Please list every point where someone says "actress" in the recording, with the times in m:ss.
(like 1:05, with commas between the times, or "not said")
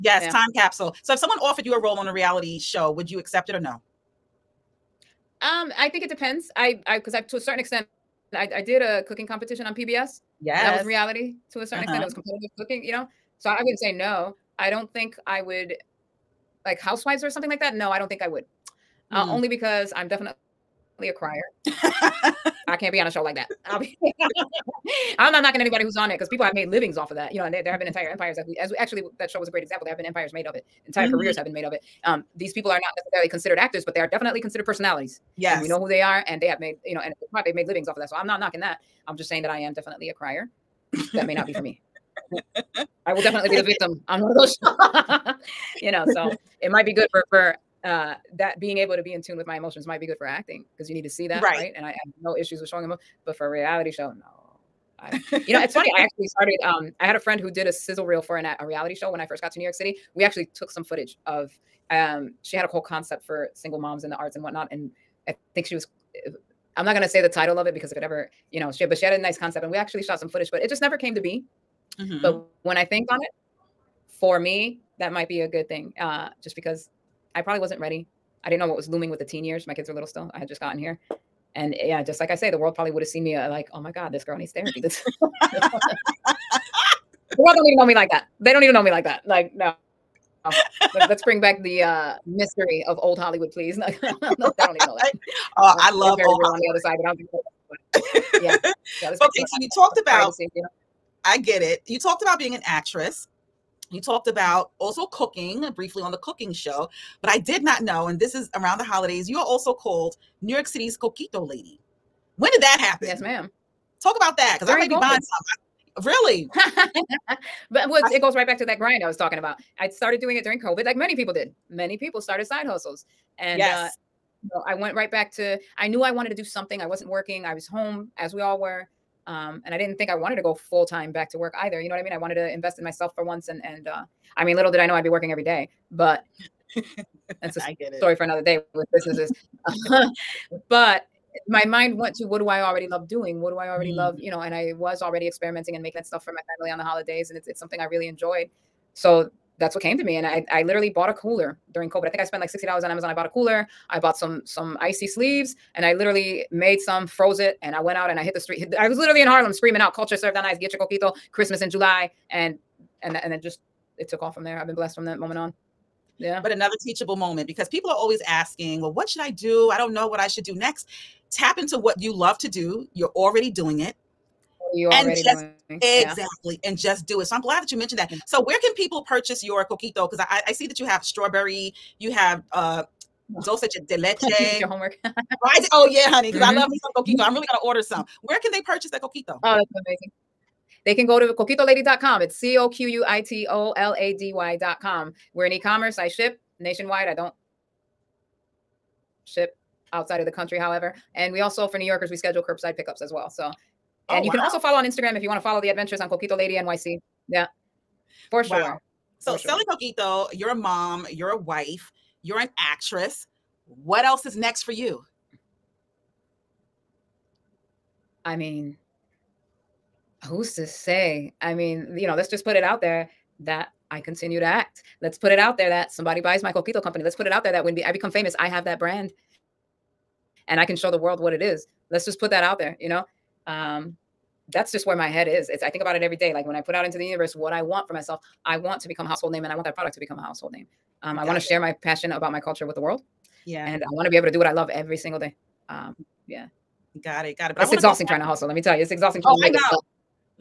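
1:42, 3:32.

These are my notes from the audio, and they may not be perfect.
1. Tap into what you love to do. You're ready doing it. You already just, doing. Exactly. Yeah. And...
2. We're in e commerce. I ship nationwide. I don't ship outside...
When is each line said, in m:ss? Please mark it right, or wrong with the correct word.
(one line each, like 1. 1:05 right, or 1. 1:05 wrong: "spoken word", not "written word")
1. 2:51 wrong: "already", not "ready"
2. 3:15 right.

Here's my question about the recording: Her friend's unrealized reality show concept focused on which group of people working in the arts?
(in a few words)
single moms.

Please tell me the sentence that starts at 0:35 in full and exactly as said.
Yeah, we know who they are, and they have made you know, and they've made livings off of that.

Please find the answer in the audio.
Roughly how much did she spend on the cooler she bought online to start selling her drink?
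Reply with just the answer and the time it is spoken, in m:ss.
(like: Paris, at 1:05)
$60, at 2:32.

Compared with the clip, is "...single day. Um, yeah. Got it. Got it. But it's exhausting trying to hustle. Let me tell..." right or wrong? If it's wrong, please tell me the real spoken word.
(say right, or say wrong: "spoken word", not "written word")
right.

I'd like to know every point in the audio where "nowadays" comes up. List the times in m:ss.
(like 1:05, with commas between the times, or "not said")
not said.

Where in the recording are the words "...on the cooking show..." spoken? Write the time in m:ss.
1:46.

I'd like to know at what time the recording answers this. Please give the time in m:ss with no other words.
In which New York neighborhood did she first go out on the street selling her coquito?
2:39.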